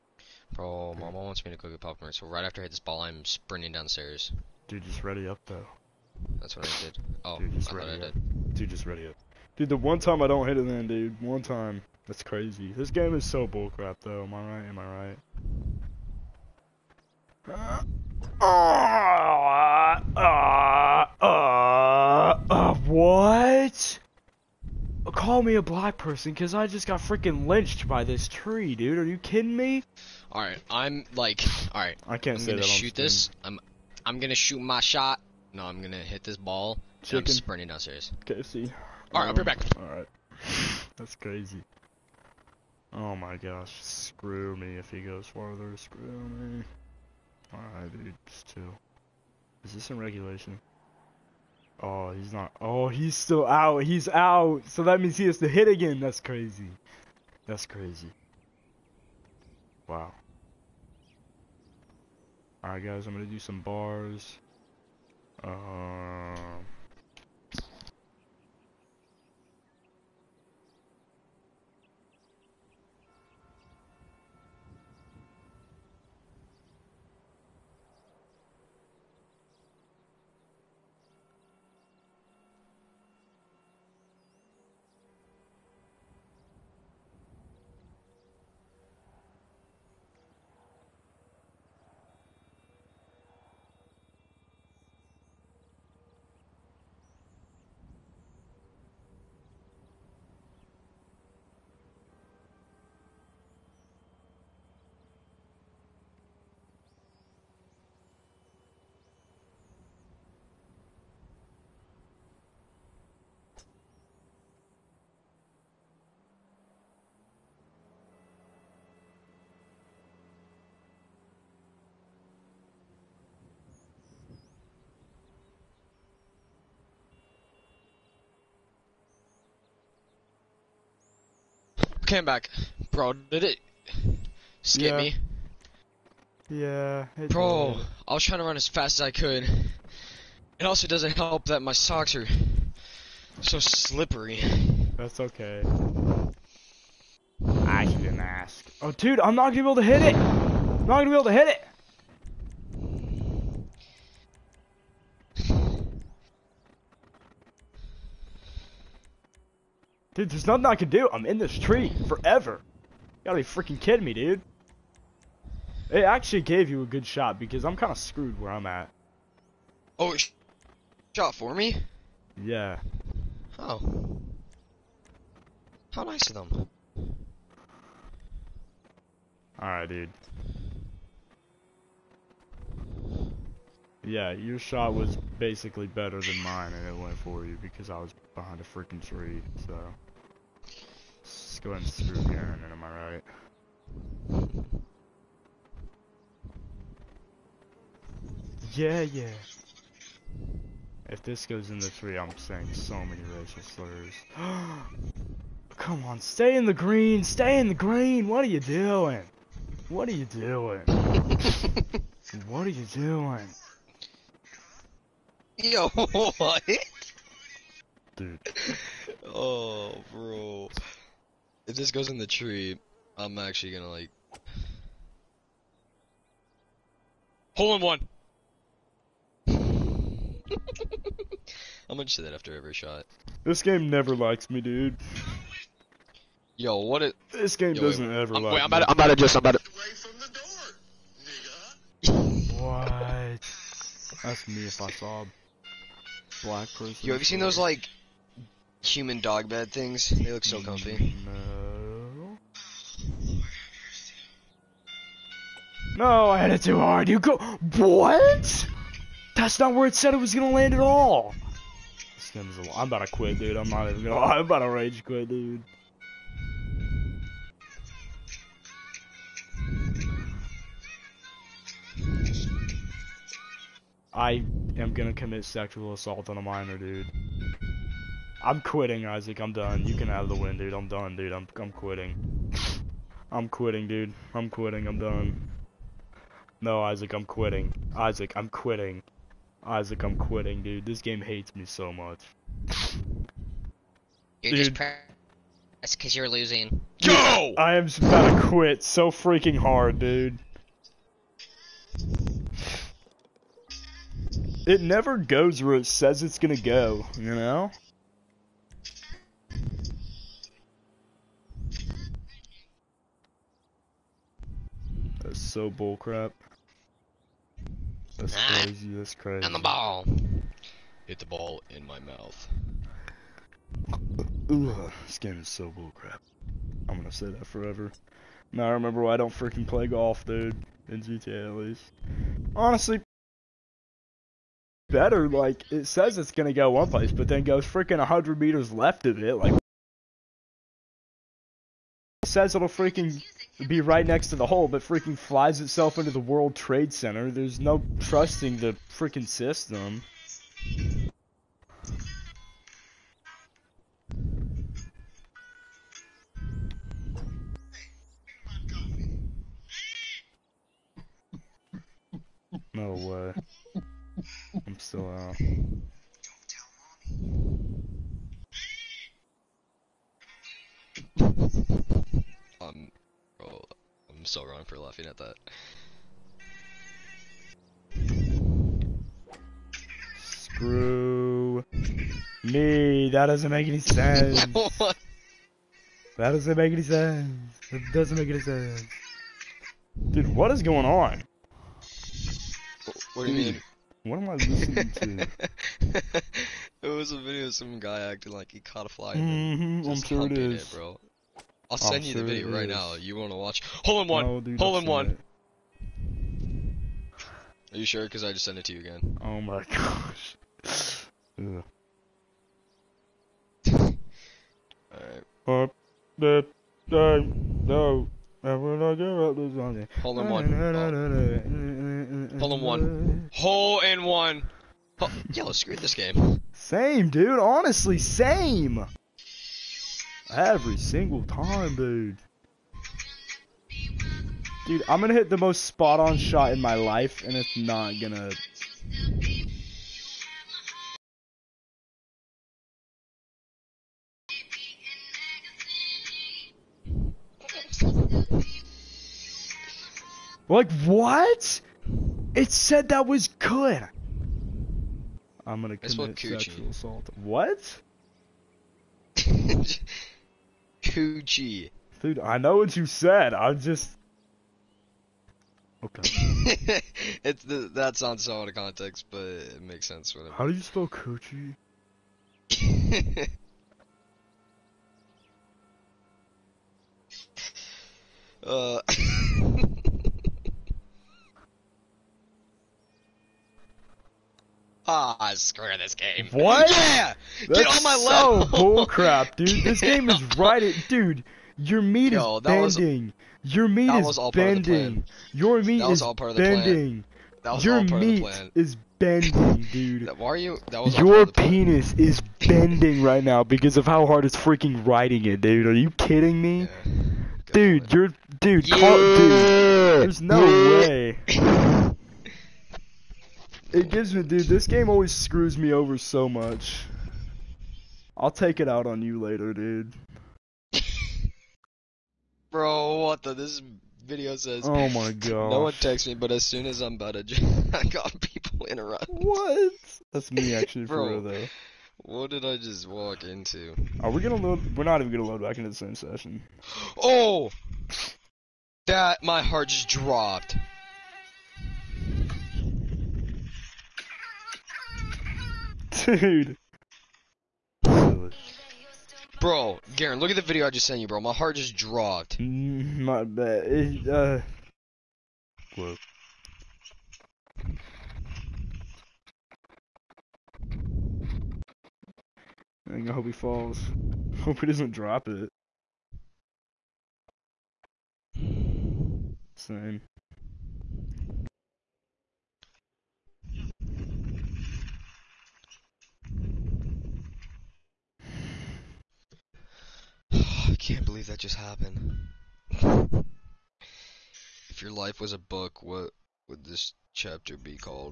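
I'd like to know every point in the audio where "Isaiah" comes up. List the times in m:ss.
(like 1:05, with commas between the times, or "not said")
not said.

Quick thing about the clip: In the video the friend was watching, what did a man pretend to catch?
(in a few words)
A fly.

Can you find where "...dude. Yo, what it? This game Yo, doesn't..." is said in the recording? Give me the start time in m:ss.
3:54.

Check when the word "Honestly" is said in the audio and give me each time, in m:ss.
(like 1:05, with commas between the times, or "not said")
5:32, 7:07.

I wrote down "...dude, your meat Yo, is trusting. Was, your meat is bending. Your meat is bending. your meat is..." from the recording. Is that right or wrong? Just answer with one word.
wrong.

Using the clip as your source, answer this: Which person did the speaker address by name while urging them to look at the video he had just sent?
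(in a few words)
Garren.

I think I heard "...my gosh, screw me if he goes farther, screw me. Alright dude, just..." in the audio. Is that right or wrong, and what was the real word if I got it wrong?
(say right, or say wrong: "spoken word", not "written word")
right.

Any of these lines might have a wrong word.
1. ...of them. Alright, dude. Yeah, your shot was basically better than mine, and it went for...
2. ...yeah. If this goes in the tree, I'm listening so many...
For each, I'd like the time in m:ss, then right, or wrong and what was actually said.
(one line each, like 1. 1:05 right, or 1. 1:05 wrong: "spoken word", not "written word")
1. 2:56 right
2. 3:19 wrong: "saying", not "listening".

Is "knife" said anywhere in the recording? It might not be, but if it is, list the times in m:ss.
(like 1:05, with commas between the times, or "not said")
not said.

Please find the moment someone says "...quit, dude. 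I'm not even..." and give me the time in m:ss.
4:23.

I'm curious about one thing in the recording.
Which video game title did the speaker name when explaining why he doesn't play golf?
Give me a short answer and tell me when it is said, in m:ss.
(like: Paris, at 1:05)
GTA, at 5:31.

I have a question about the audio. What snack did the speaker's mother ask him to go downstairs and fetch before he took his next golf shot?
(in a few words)
Popcorn.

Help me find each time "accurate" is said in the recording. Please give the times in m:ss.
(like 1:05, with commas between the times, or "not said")
not said.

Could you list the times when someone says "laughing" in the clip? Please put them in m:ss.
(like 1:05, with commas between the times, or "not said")
6:14.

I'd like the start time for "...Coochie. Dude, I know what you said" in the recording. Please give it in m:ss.
7:40.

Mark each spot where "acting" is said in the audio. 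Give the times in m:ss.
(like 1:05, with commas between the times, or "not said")
6:38.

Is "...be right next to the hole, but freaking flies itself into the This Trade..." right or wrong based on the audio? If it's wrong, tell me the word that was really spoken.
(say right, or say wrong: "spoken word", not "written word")
wrong: "World", not "This".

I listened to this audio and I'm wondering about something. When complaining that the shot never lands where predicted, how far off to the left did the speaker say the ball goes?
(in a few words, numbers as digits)
100 meters.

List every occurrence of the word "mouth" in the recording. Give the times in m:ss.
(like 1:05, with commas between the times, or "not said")
5:21.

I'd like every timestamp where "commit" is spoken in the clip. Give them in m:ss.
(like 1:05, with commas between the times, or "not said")
4:35, 7:35.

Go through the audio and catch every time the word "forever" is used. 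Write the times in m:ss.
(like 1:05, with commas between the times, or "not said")
2:42, 5:27.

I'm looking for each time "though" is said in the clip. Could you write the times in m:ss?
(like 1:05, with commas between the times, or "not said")
0:05, 0:14, 8:51.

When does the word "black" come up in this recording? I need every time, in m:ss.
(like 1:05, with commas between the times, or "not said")
0:25, 4:06.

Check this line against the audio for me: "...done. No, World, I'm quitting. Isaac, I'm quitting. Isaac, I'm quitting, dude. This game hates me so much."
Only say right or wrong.
wrong.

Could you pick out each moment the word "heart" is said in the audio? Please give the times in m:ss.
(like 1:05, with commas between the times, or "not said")
8:59, 9:11.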